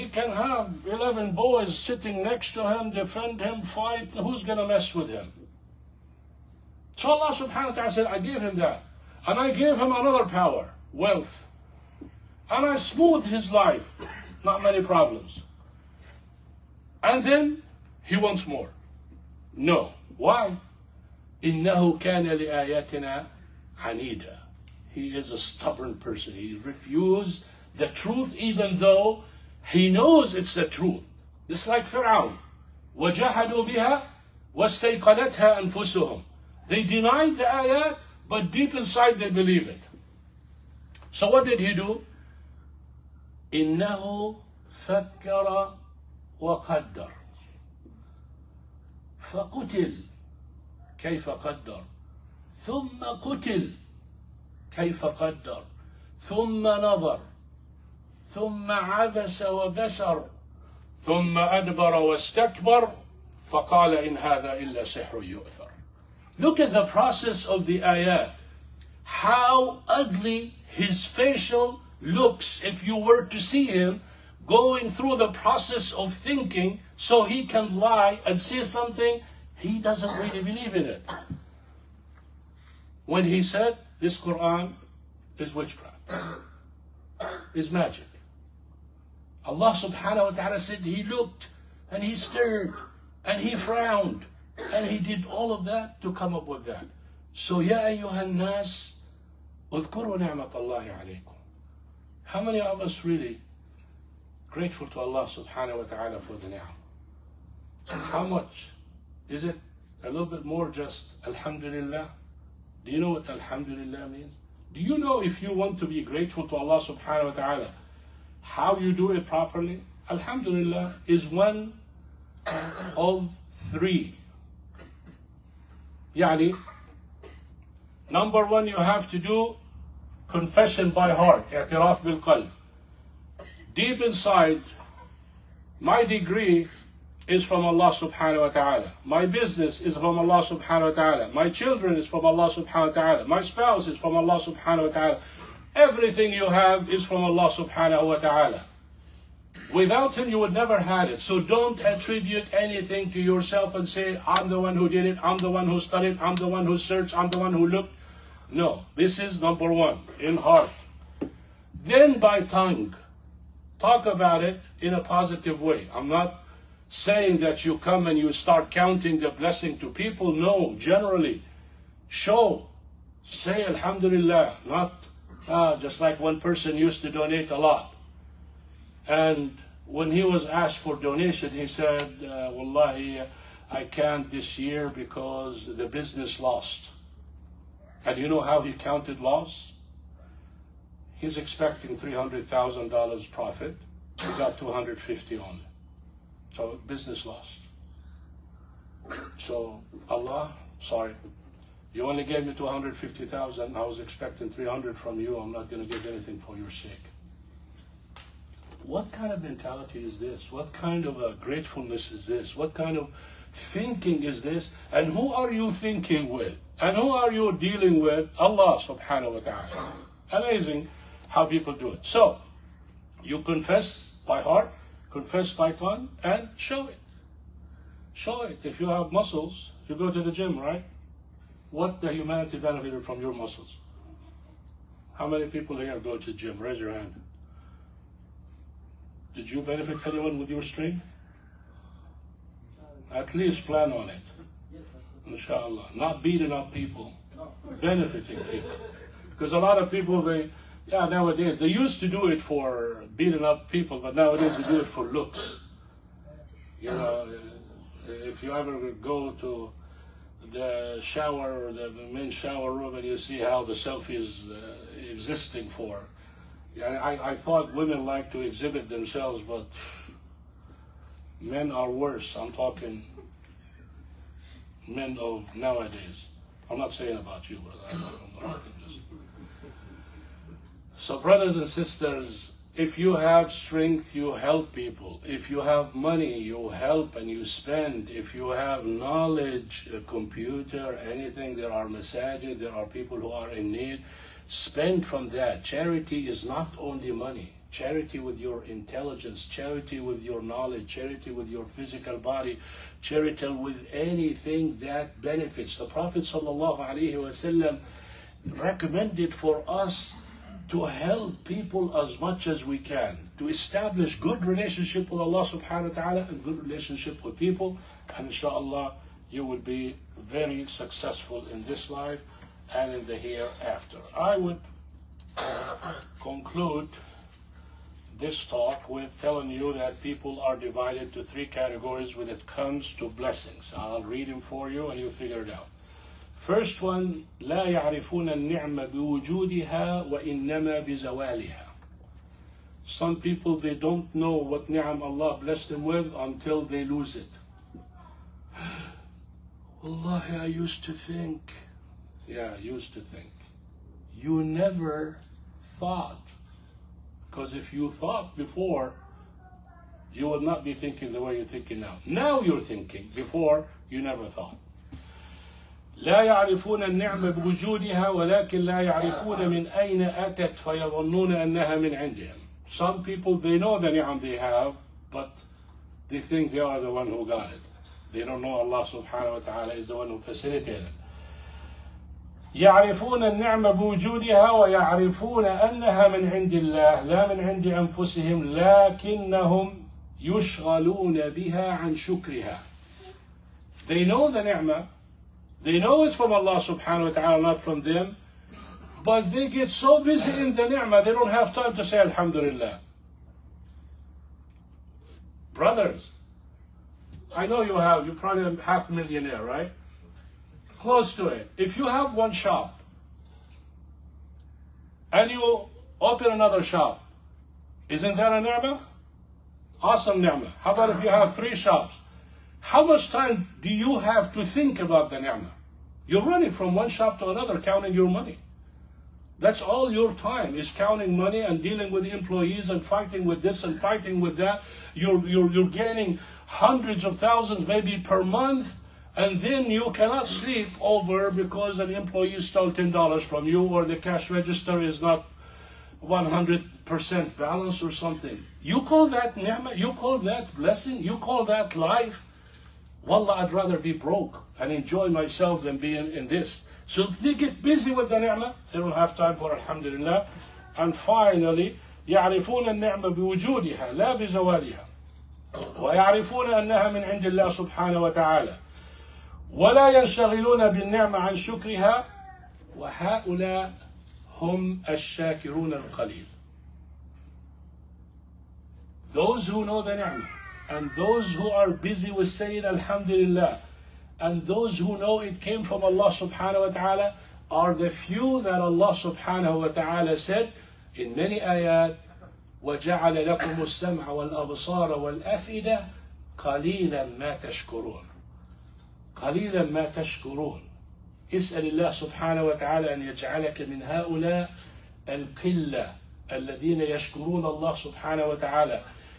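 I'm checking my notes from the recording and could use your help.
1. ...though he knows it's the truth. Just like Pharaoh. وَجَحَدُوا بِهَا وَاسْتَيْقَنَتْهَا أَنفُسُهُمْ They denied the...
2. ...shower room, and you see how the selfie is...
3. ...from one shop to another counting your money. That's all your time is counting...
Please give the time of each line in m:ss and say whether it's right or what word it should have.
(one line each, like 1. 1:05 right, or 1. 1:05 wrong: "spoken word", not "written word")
1. 0:28 right
2. 4:22 right
3. 7:06 right.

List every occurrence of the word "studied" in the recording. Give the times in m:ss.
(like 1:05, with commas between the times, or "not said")
2:35.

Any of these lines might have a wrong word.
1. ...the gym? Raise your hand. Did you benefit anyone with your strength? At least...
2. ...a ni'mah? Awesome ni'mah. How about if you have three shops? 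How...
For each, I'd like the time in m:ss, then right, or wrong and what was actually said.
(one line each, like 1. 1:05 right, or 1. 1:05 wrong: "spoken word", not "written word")
1. 3:56 right
2. 6:58 right.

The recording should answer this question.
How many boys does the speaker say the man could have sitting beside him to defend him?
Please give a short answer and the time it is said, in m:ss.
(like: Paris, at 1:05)
11, at 0:00.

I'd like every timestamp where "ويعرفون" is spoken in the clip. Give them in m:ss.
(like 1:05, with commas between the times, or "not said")
6:24, 7:45.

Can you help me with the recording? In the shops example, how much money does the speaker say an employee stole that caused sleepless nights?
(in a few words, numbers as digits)
$10.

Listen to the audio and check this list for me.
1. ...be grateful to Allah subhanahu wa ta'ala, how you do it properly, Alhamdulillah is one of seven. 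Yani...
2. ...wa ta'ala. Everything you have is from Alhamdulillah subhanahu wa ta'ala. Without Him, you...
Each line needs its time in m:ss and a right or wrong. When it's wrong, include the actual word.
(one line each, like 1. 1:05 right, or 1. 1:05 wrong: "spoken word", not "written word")
1. 1:55 wrong: "three", not "seven"
2. 2:24 wrong: "Allah", not "Alhamdulillah".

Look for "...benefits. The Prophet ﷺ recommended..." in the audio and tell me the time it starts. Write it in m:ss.
5:05.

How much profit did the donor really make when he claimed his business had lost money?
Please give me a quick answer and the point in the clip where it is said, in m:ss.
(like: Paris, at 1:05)
250,000, at 3:14.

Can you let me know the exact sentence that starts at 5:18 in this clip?
And inshallah, you will be very successful in this life and in the hereafter.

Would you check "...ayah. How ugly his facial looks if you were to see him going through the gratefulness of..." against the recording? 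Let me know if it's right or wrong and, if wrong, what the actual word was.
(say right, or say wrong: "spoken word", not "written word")
wrong: "process", not "gratefulness".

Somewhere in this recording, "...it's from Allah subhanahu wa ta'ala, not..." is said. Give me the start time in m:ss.
6:36.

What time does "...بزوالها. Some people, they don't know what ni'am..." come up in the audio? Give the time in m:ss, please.
5:40.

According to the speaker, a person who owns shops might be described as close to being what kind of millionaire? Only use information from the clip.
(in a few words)
half millionaire.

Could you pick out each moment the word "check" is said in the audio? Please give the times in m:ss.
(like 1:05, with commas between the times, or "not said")
not said.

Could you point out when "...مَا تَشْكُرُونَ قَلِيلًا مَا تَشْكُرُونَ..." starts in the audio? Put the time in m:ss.
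8:17.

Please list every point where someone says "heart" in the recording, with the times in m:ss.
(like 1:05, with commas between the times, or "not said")
2:11, 2:40, 3:44.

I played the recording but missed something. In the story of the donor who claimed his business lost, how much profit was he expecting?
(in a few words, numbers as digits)
$300,000.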